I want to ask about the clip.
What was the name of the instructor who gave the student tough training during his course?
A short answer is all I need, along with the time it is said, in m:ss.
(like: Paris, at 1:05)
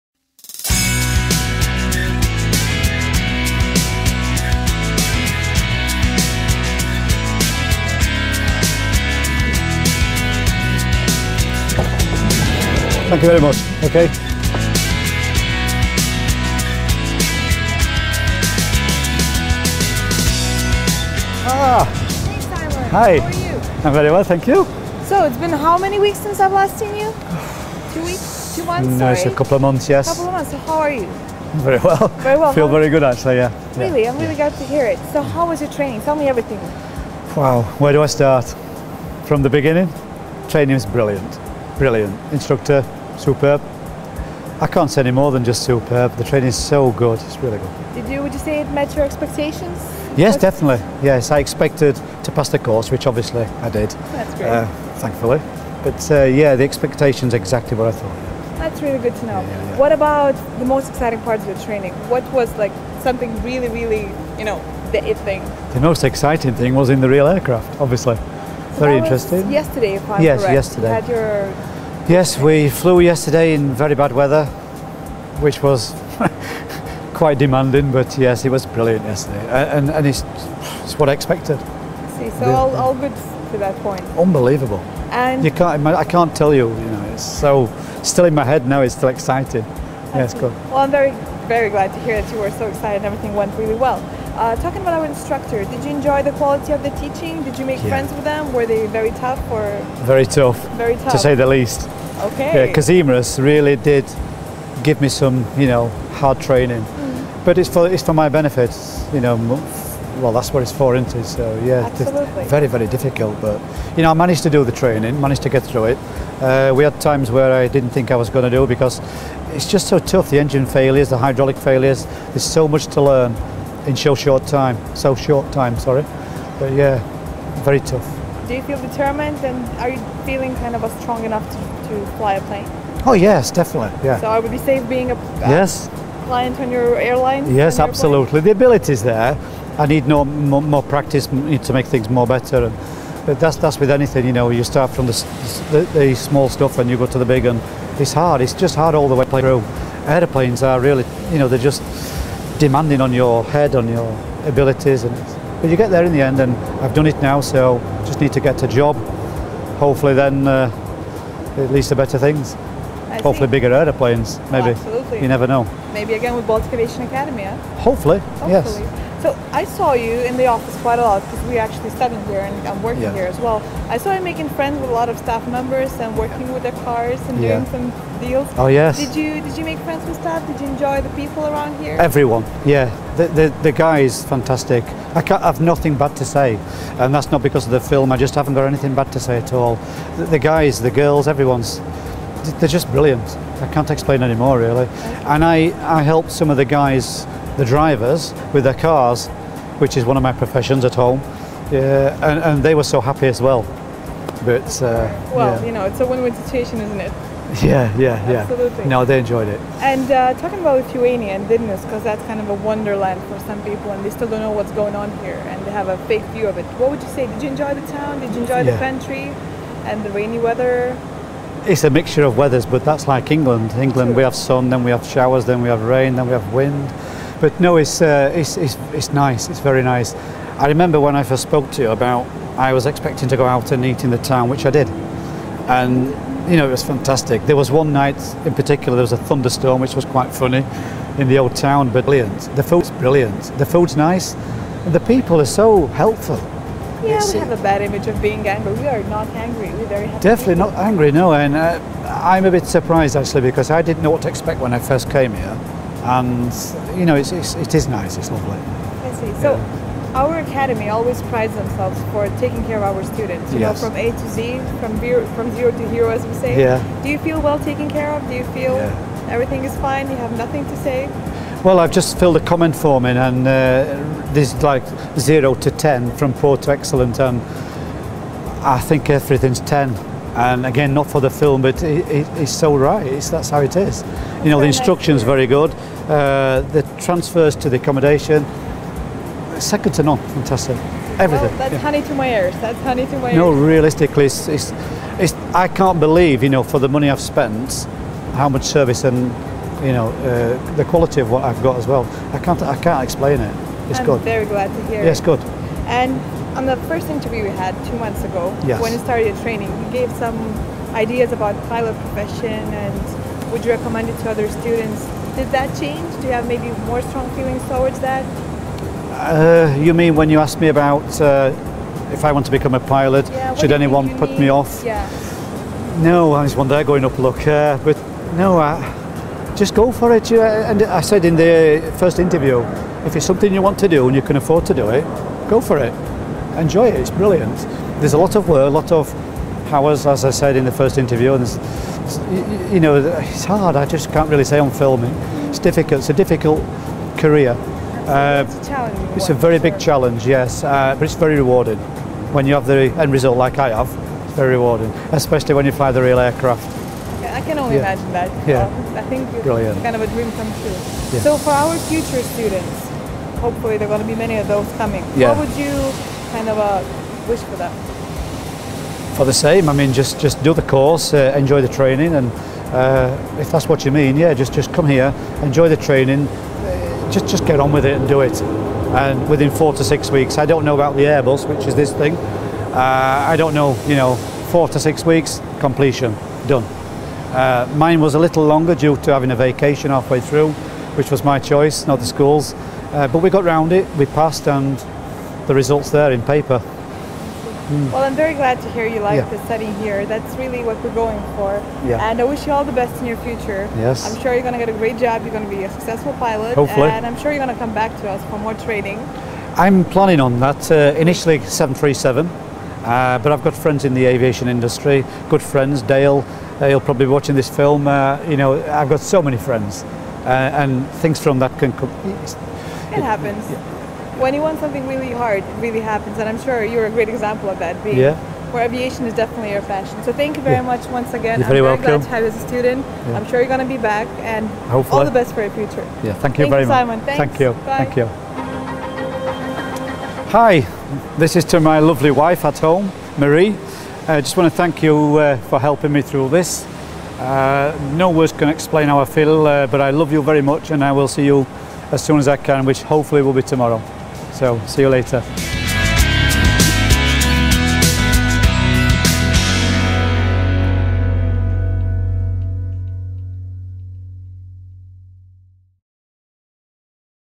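Kazimras, at 1:42.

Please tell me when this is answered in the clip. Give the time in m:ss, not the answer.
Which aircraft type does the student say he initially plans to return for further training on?
6:51.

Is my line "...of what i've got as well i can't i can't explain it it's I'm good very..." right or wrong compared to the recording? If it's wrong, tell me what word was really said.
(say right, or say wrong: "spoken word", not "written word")
right.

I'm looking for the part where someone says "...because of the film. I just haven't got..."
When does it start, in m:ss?
3:07.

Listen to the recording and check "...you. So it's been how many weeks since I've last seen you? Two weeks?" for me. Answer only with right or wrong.
right.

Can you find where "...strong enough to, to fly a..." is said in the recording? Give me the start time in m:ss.
2:11.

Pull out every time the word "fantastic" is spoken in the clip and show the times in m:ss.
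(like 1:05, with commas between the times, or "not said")
3:04, 3:56, 4:50.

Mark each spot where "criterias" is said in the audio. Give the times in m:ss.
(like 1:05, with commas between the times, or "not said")
not said.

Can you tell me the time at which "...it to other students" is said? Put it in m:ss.
5:14.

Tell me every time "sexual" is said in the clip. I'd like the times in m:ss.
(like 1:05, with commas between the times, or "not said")
not said.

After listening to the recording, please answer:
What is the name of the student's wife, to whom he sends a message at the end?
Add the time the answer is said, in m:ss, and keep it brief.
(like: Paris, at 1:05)
Marie, at 7:23.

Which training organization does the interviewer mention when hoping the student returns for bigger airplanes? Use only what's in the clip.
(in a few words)
Baltic Aviation Academy.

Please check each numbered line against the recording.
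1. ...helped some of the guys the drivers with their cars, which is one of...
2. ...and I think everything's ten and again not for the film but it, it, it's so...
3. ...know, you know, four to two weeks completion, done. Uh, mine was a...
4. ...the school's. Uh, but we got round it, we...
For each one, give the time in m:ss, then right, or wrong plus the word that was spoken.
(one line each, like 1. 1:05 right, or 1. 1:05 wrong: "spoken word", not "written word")
1. 3:16 right
2. 4:37 right
3. 6:23 wrong: "six", not "two"
4. 6:31 right.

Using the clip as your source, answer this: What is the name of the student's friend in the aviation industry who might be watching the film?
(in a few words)
Dale.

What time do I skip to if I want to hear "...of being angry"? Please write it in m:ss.
4:08.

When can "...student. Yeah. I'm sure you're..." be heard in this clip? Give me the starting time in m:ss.
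7:12.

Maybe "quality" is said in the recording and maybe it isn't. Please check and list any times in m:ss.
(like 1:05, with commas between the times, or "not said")
1:36, 5:00.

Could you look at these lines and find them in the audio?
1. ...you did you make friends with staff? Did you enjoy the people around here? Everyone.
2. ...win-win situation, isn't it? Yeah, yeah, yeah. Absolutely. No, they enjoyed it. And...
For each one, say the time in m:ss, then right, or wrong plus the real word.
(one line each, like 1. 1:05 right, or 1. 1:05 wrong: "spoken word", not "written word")
1. 2:59 right
2. 3:26 right.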